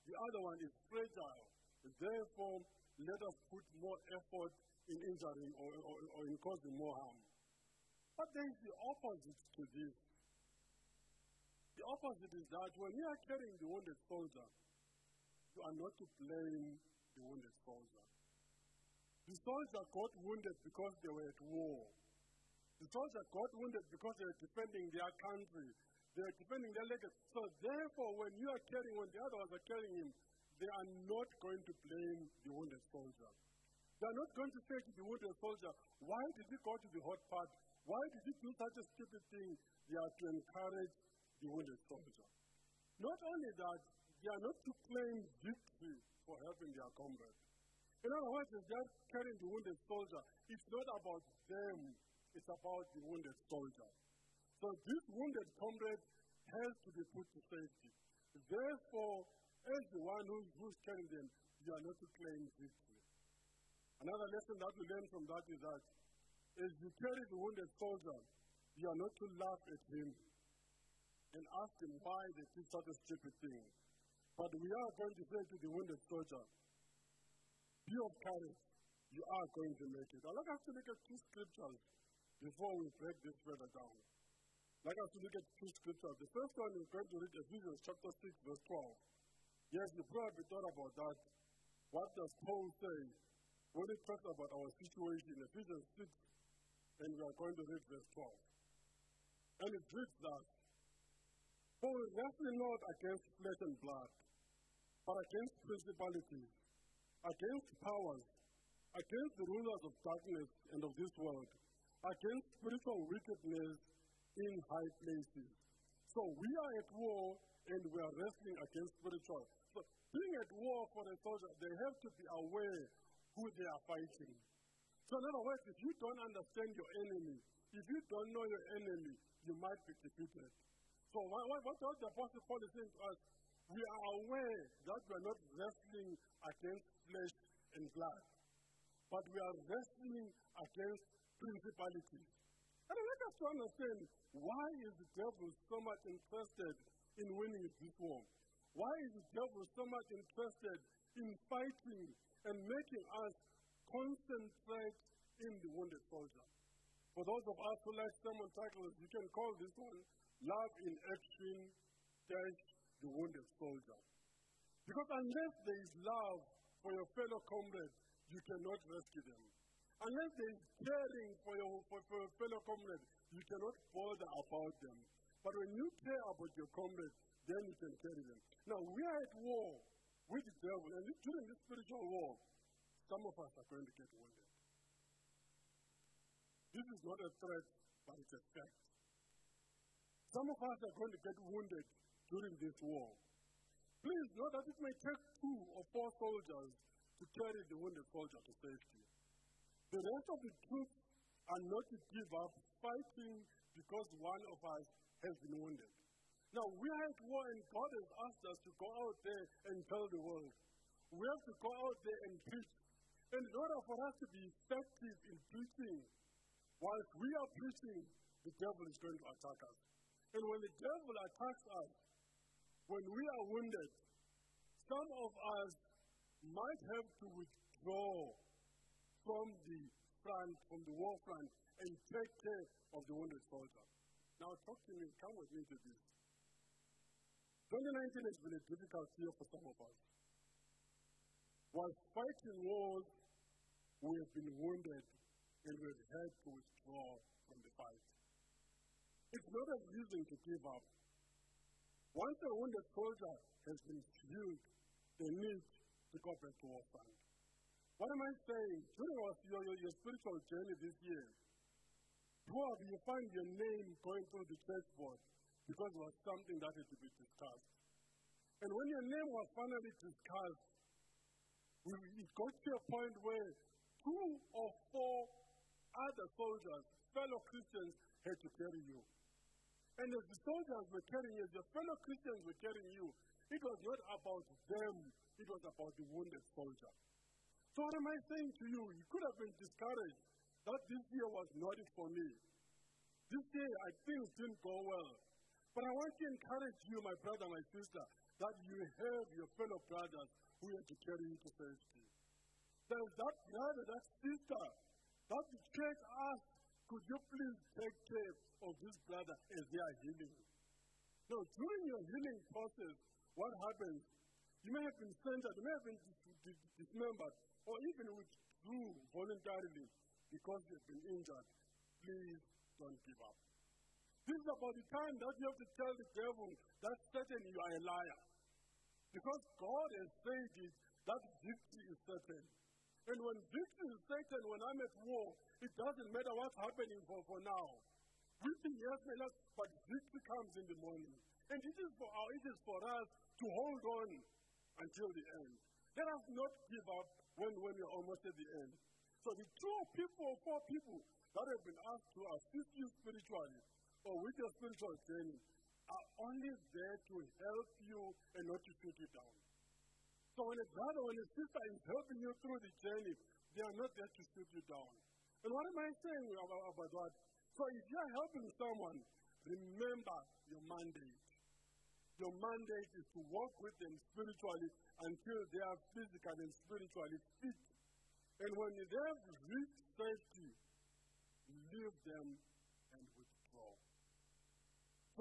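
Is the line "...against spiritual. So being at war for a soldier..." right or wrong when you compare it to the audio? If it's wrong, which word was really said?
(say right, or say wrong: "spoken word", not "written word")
right.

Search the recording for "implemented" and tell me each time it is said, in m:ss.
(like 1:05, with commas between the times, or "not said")
not said.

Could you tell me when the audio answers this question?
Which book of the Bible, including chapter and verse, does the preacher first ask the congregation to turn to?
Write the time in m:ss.
1:27.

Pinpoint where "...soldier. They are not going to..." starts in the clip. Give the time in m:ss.
0:32.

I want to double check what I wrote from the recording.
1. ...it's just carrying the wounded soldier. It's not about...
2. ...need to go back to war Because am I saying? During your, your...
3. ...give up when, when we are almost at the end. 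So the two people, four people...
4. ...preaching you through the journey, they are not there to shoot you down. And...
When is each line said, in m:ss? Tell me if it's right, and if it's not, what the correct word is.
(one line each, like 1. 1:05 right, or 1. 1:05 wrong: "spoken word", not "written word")
1. 0:48 right
2. 4:15 wrong: "What", not "Because"
3. 5:46 right
4. 6:01 wrong: "helping", not "preaching".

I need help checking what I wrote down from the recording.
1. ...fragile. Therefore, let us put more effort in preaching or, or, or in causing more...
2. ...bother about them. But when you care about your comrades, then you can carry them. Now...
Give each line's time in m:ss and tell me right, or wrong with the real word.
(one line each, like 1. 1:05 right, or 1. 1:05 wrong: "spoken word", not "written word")
1. 0:00 wrong: "injuring", not "preaching"
2. 2:53 right.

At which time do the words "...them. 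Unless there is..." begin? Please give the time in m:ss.
2:49.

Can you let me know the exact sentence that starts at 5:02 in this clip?
There is that brother, that sister, that the church asks could you please take care of this brother as they are healing?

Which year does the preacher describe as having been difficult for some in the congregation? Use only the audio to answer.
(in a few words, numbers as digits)
2019.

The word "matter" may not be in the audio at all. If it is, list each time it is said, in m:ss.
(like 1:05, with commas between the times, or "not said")
5:36.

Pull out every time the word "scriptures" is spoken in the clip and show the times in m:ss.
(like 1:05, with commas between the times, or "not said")
1:21, 1:25.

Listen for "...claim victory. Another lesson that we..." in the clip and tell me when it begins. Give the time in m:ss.
1:02.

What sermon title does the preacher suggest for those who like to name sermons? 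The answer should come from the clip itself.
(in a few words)
Love in Action.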